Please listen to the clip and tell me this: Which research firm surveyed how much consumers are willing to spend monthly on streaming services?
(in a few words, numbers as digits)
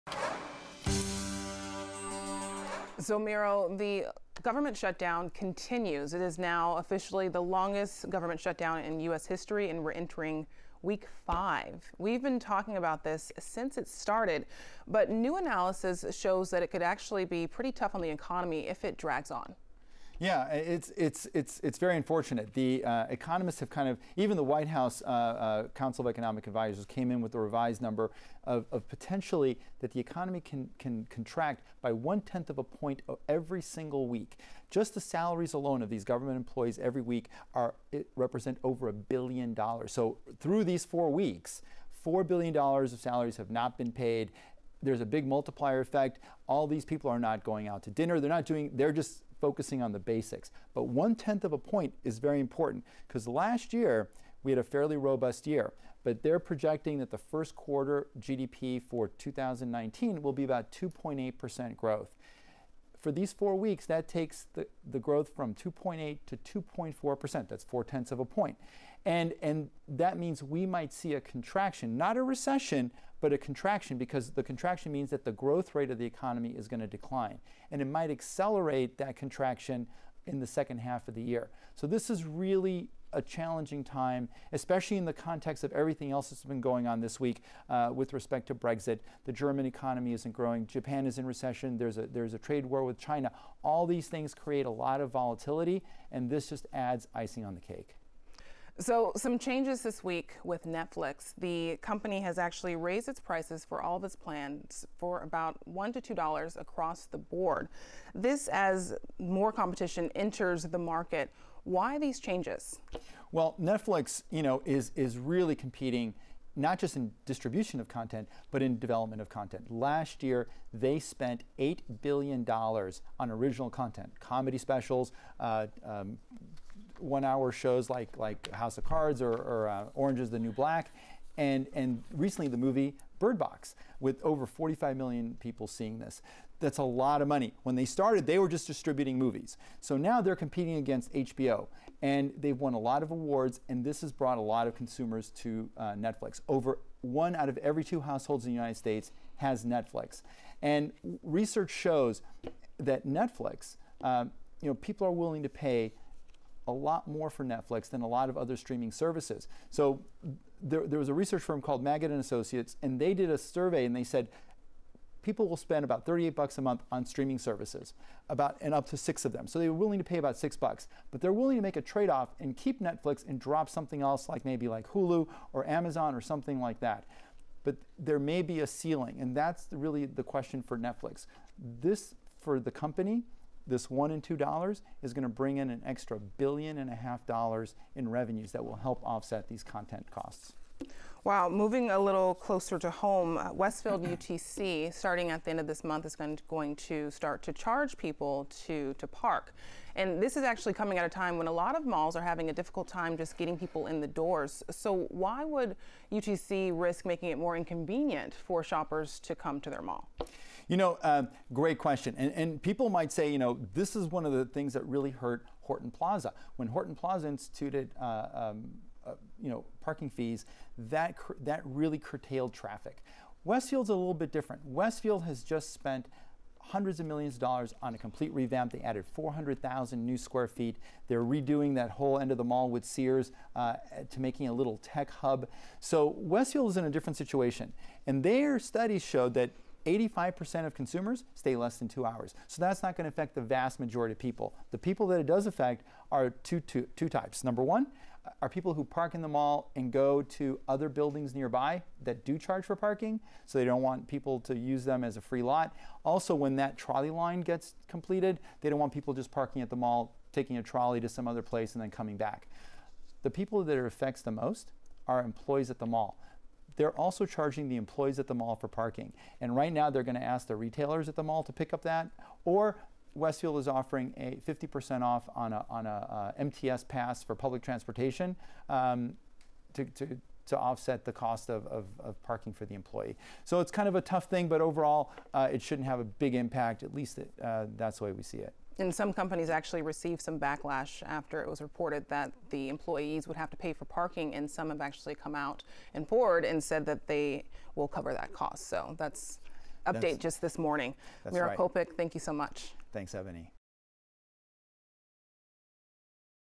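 Magid and Associates.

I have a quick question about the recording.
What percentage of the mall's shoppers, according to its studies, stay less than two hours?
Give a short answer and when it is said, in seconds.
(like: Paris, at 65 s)
85%, at 239 s.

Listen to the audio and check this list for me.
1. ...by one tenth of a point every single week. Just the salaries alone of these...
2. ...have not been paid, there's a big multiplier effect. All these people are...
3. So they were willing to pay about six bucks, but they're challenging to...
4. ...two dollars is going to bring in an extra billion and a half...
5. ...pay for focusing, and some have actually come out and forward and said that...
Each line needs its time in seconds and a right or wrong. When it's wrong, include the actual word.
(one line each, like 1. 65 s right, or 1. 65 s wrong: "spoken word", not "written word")
1. 31 s right
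2. 43 s right
3. 169 s wrong: "willing", not "challenging"
4. 184 s right
5. 293 s wrong: "parking", not "focusing".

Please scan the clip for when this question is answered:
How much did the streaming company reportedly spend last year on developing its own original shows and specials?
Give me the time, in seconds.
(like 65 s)
121 s.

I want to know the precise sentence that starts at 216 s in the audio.
When Horton Plaza instituted uh, um, uh, you know, parking fees, that, that really curtailed traffic.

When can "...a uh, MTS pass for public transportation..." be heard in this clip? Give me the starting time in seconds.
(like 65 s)
275 s.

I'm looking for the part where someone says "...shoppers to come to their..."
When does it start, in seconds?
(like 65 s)
208 s.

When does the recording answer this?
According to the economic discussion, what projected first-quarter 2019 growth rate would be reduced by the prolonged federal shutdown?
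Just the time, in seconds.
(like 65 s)
60 s.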